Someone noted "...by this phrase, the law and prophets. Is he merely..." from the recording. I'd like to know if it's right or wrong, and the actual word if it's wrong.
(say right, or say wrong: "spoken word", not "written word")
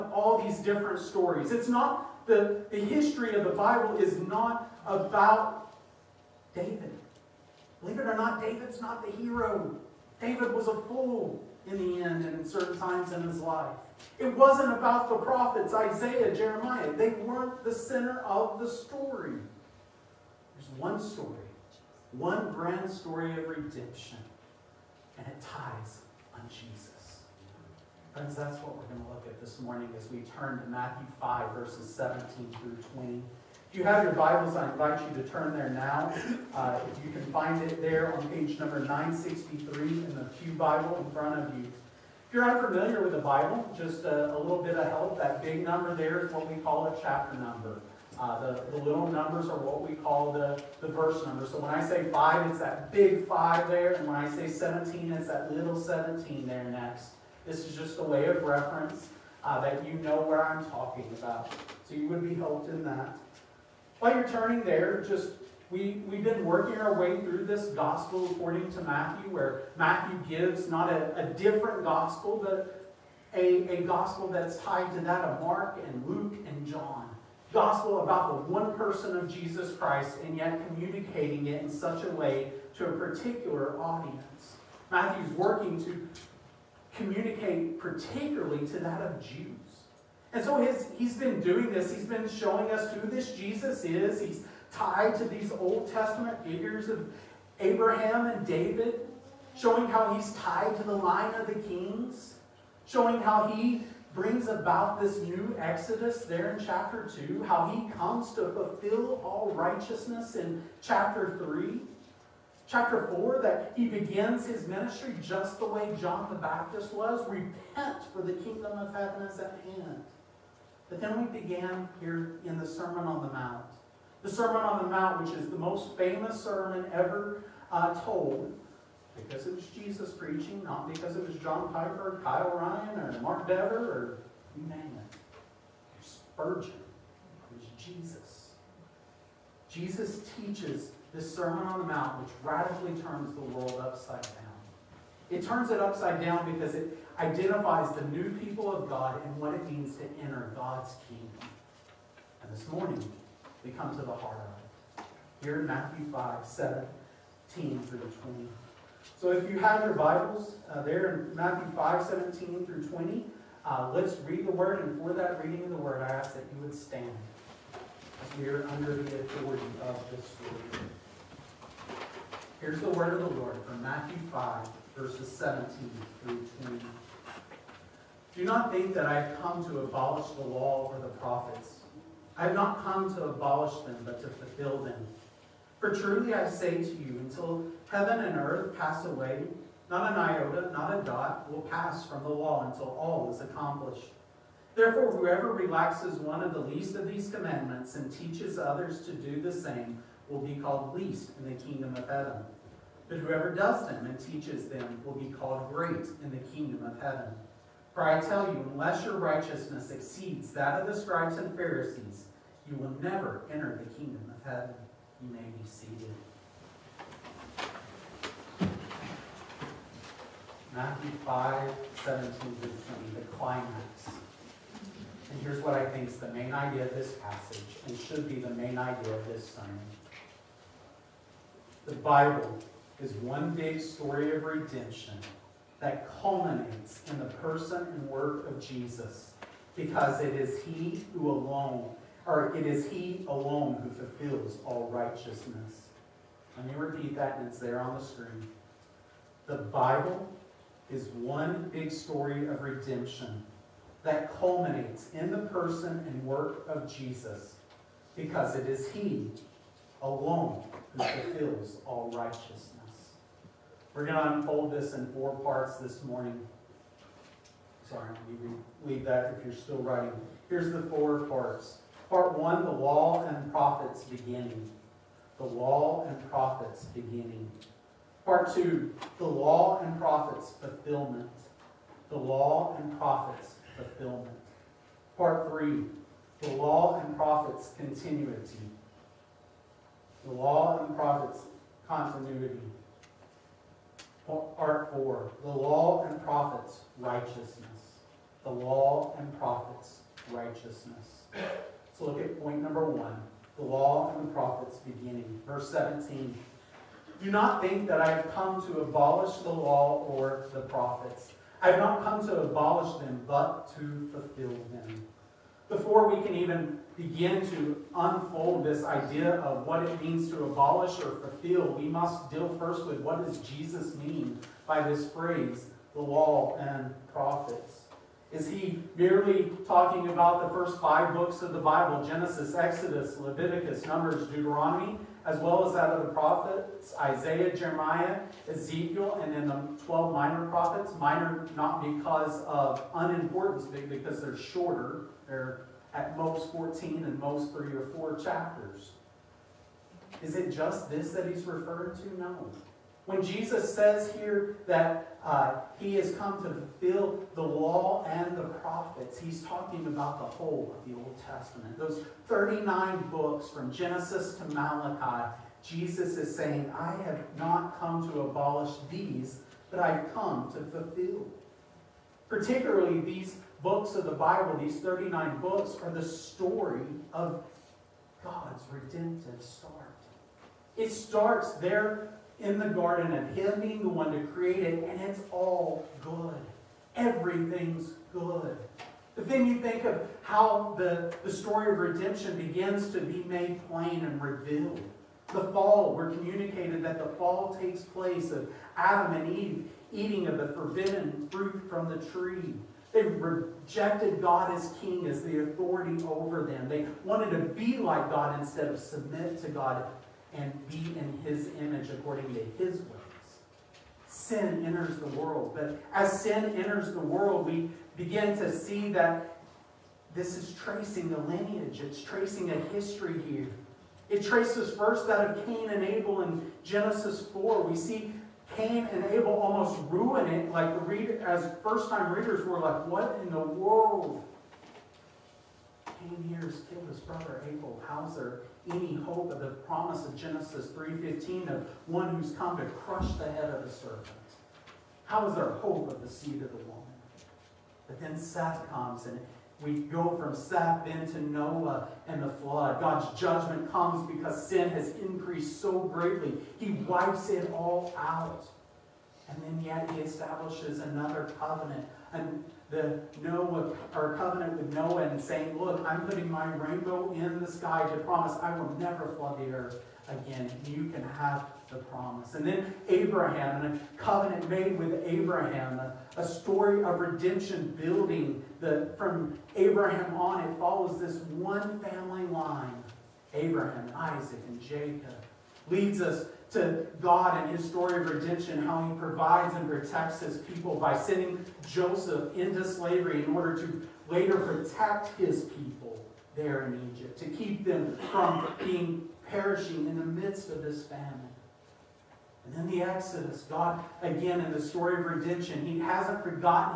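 right.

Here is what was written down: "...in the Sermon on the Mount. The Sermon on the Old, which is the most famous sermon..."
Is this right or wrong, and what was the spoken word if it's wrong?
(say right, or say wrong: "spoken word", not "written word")
wrong: "Mount", not "Old".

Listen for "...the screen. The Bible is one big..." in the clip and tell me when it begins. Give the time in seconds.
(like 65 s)
247 s.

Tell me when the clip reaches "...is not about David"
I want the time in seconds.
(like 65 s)
3 s.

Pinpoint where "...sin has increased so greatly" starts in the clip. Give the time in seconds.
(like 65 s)
454 s.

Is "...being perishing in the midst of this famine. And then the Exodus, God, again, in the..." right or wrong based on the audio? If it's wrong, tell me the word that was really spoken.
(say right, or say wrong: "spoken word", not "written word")
right.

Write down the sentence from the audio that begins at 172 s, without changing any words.
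Here's the word of the Lord from Matthew 5, verses 17 through 20.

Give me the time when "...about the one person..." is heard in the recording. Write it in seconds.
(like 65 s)
78 s.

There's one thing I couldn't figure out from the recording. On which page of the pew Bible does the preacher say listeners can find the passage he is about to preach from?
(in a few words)
963.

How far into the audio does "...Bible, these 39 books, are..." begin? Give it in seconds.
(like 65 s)
374 s.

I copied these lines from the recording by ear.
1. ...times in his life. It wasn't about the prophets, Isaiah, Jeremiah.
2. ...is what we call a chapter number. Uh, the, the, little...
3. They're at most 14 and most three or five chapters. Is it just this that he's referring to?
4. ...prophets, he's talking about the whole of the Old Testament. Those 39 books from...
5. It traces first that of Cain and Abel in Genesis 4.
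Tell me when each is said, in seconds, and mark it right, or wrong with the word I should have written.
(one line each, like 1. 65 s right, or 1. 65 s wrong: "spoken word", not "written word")
1. 12 s right
2. 46 s right
3. 345 s wrong: "four", not "five"
4. 358 s right
5. 424 s right.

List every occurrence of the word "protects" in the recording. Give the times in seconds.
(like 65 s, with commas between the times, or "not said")
489 s, 494 s.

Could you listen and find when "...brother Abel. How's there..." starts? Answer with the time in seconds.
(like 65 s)
436 s.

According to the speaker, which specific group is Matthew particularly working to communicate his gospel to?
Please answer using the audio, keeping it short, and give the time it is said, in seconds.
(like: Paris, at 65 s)
Jews, at 89 s.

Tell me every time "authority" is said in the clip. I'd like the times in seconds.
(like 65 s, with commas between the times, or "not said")
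169 s, 405 s.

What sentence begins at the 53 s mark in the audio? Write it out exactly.
And when I say 17, it's that little 17 there next.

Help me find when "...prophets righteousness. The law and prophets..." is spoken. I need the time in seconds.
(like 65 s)
296 s.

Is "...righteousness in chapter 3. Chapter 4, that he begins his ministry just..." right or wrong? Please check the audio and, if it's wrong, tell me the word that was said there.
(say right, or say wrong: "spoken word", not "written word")
right.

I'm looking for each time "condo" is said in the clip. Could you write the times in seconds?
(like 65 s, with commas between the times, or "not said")
not said.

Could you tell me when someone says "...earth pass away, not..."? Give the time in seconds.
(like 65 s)
188 s.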